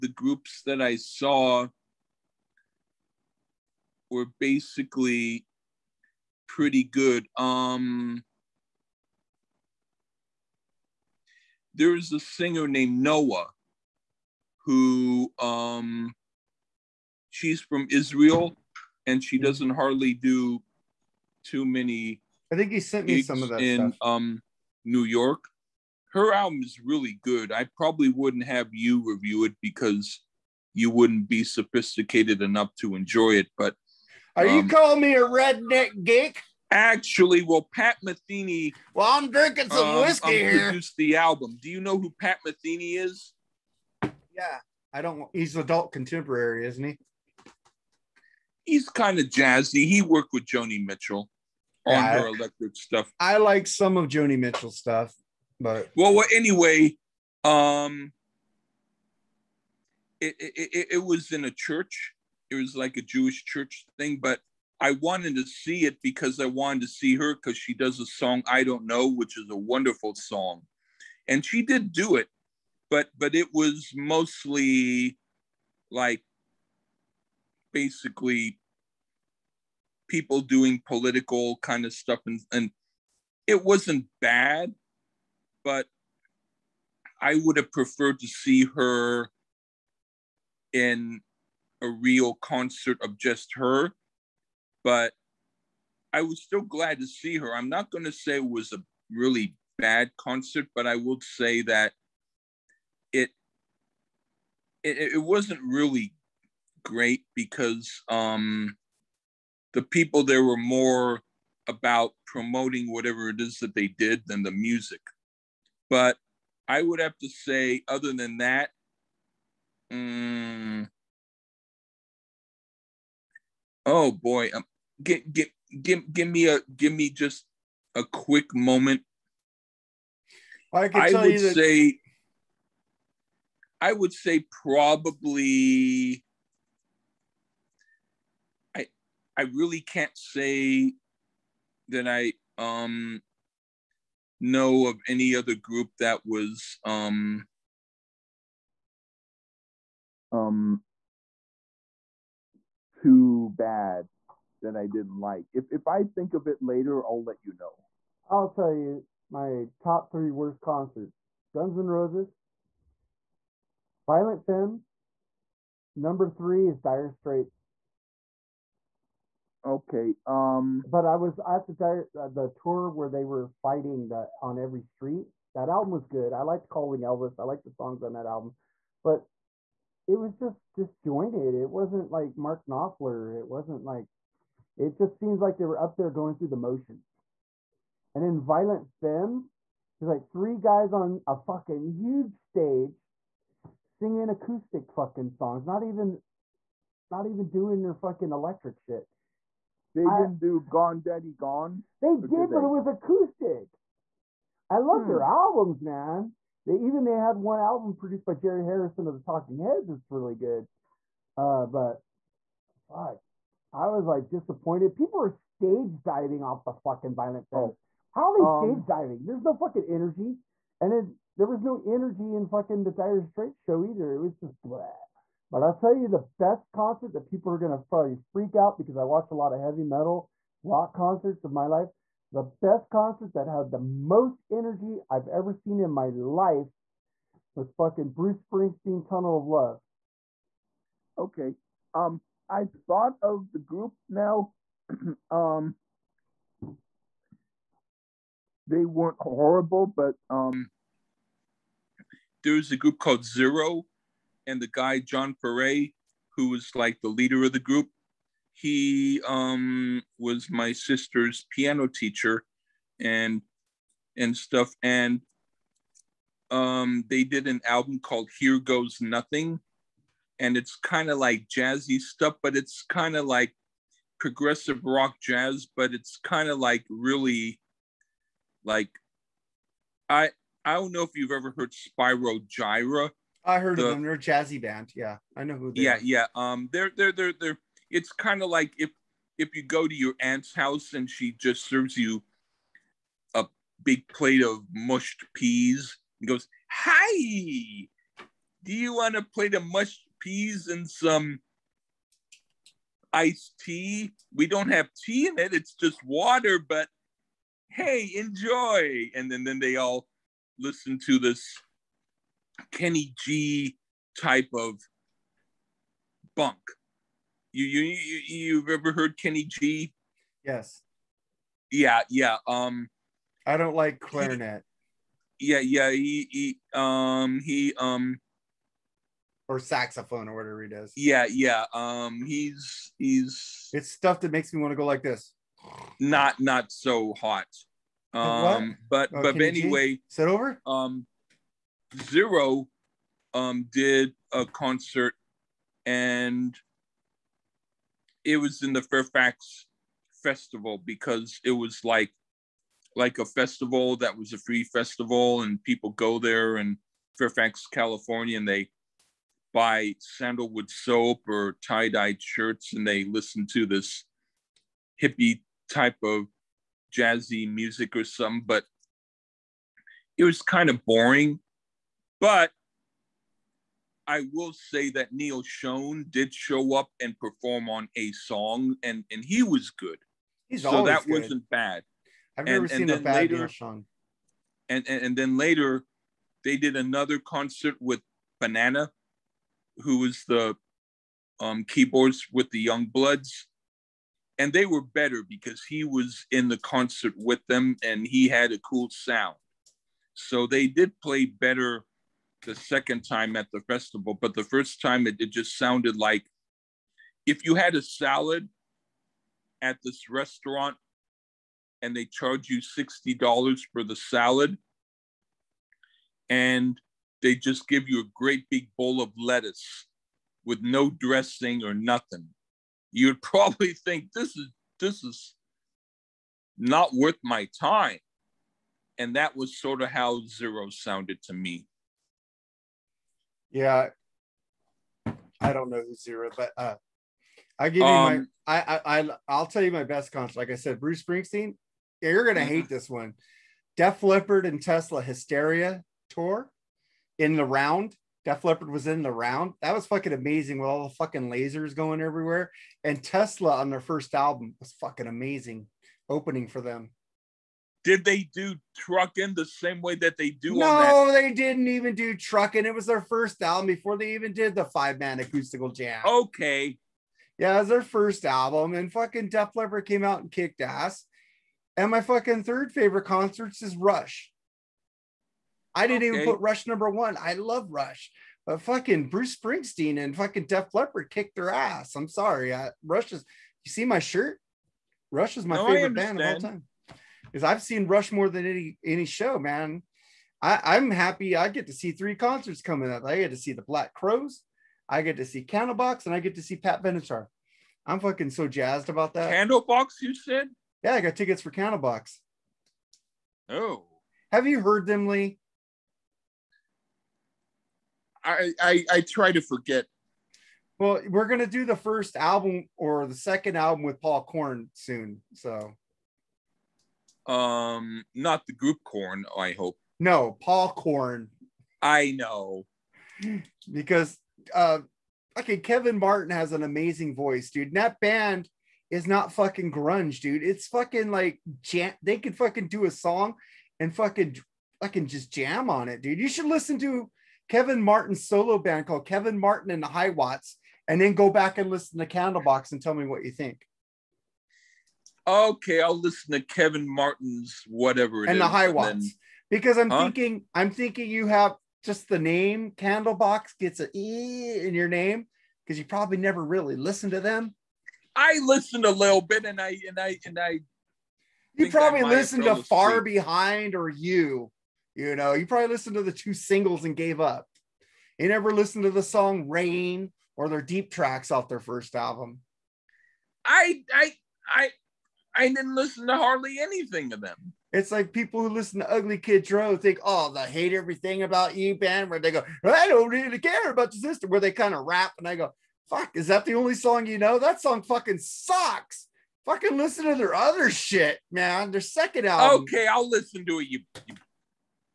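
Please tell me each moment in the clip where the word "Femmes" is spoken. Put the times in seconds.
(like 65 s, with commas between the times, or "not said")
164 s, 188 s.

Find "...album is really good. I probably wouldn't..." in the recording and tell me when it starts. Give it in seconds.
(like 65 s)
26 s.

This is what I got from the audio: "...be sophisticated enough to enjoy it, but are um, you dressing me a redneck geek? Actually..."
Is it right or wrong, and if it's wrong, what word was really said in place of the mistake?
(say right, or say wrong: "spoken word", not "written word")
wrong: "calling", not "dressing".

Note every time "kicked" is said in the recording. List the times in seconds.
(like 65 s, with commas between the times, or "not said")
470 s, 481 s.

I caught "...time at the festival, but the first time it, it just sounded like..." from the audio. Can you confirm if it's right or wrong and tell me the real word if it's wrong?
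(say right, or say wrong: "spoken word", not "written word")
right.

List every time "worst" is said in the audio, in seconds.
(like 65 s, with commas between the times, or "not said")
160 s.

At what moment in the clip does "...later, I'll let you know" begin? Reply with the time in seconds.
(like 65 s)
156 s.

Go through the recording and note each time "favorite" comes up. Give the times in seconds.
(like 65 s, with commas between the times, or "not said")
472 s, 485 s.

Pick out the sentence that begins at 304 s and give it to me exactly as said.
We don't have tea in it; it's just water, but." Hey, enjoy.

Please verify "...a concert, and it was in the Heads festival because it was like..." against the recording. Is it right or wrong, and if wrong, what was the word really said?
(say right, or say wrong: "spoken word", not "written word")
wrong: "Fairfax", not "Heads".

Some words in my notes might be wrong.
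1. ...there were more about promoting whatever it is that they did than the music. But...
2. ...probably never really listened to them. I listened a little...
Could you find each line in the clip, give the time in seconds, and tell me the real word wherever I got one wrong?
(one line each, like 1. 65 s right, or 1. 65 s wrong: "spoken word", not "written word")
1. 110 s right
2. 555 s right.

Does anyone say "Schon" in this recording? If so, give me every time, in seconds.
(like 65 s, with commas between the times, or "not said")
375 s, 383 s.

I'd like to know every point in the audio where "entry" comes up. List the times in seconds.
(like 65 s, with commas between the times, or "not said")
not said.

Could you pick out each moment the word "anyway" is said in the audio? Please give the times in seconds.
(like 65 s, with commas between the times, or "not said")
56 s, 339 s.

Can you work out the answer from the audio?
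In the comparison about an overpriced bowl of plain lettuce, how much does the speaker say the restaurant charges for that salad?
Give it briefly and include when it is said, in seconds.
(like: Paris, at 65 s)
$60, at 412 s.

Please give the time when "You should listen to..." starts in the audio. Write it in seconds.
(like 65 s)
536 s.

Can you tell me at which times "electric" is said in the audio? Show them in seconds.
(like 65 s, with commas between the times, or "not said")
52 s, 198 s.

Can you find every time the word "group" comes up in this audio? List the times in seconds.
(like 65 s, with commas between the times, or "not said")
0 s, 145 s, 243 s, 252 s, 257 s, 518 s.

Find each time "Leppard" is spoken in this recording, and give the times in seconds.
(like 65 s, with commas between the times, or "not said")
444 s, 448 s, 469 s, 480 s.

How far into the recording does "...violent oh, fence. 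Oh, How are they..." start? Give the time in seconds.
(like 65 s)
217 s.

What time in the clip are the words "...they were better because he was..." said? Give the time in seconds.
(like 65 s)
394 s.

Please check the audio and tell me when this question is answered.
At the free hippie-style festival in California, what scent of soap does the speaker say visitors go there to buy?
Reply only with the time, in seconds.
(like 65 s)
359 s.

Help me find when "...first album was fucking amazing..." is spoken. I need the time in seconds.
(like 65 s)
453 s.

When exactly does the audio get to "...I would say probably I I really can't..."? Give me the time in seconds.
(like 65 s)
133 s.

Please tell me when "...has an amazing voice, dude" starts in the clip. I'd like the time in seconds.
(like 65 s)
526 s.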